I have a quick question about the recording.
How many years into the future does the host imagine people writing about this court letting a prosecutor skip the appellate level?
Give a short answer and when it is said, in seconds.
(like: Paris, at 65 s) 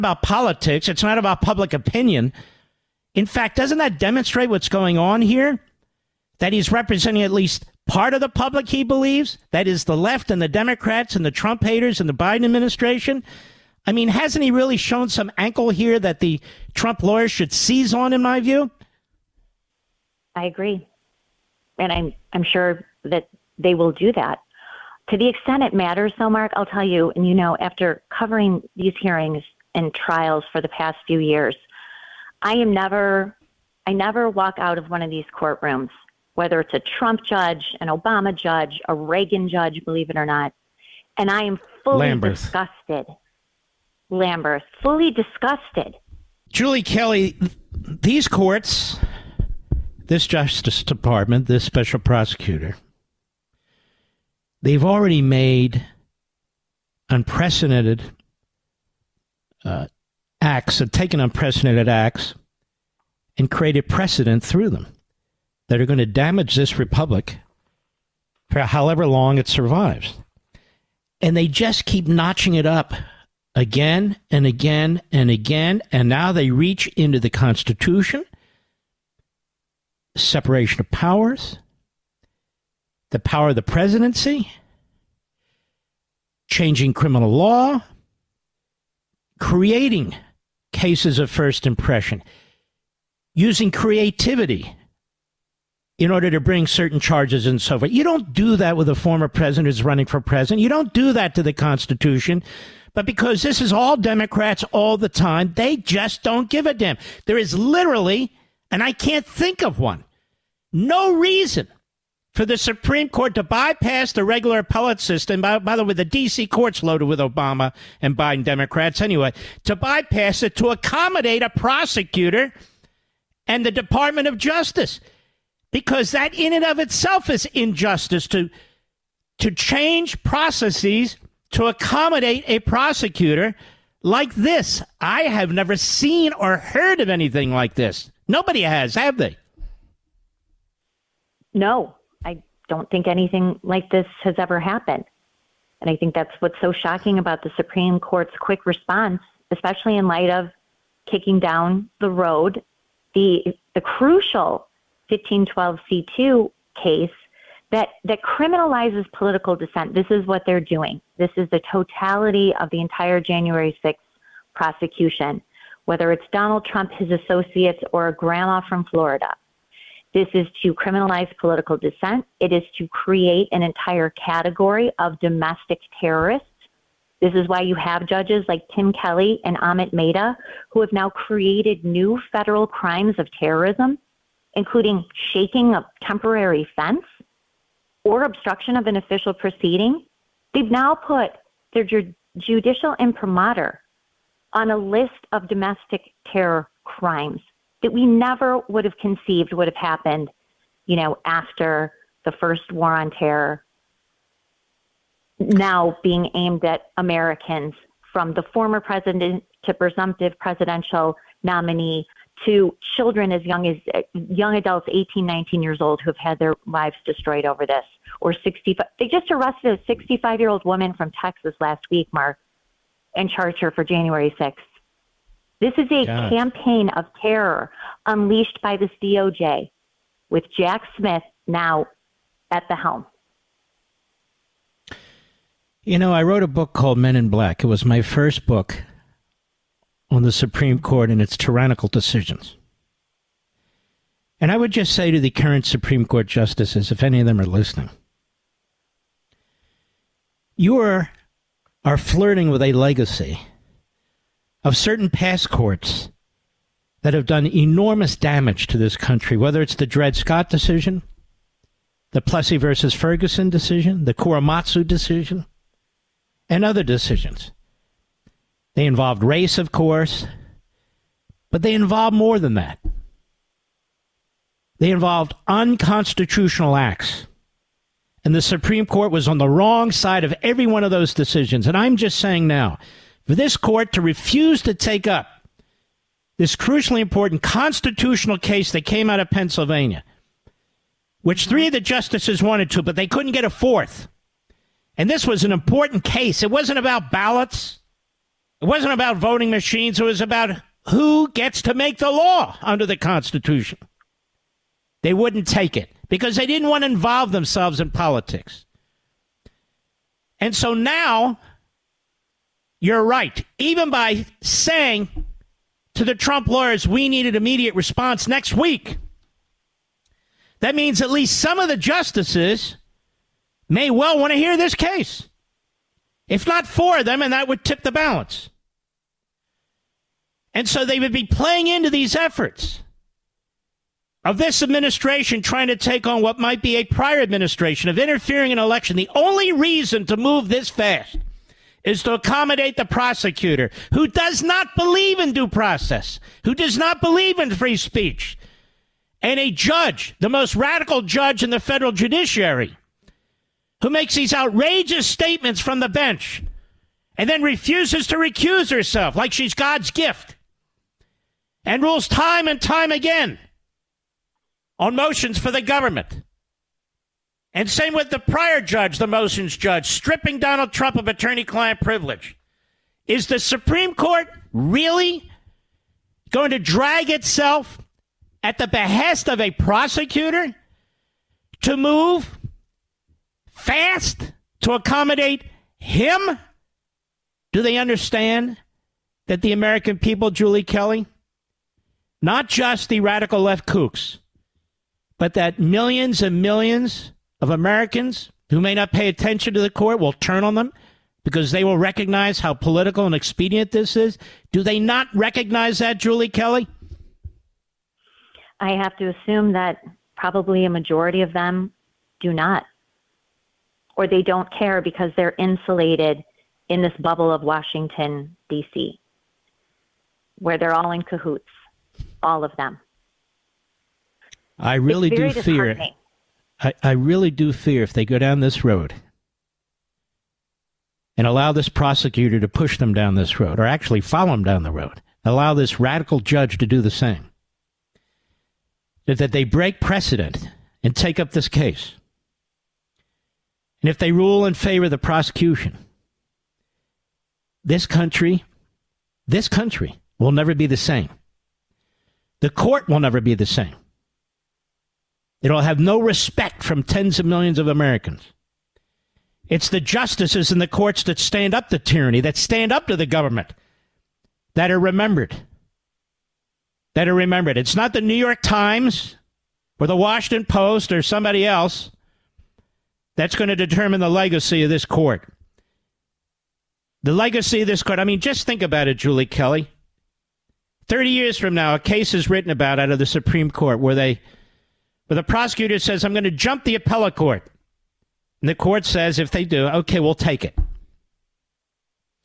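30, at 480 s.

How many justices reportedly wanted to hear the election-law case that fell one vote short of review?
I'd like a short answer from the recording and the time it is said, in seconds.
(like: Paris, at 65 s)
3, at 291 s.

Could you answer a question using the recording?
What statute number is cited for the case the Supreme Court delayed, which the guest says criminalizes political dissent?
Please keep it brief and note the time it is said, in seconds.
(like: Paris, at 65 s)
1512(c)(2), at 155 s.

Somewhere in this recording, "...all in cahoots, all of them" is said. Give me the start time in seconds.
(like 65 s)
420 s.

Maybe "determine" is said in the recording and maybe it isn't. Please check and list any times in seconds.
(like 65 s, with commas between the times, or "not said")
473 s.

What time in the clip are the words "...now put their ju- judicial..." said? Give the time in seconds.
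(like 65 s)
190 s.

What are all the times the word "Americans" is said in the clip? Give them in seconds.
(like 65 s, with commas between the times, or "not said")
206 s, 389 s, 397 s, 457 s.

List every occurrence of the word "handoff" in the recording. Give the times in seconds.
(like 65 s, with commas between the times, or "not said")
not said.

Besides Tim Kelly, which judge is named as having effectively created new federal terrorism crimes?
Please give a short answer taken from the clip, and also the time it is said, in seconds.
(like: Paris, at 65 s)
Amit Mehta, at 179 s.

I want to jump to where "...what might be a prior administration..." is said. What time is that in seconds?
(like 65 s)
336 s.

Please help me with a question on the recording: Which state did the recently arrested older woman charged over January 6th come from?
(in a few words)
Texas.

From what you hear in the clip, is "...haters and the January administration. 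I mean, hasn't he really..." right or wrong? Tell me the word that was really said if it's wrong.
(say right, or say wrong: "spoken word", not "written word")
wrong: "Biden", not "January".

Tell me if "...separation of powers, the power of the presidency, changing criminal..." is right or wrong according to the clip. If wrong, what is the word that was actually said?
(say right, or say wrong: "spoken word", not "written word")
right.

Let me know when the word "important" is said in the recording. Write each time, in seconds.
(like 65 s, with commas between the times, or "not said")
286 s, 295 s.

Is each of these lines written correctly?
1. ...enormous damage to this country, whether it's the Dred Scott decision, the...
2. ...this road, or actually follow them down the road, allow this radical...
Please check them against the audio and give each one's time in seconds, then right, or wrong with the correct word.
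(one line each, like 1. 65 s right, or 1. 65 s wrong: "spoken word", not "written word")
1. 257 s right
2. 433 s right.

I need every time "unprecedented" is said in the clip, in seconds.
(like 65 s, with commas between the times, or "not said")
57 s, 61 s.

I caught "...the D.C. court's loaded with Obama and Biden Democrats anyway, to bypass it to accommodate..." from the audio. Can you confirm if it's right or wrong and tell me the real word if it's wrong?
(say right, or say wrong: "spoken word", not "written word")
right.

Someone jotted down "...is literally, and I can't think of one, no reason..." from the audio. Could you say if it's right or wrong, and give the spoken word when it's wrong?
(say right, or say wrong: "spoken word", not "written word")
right.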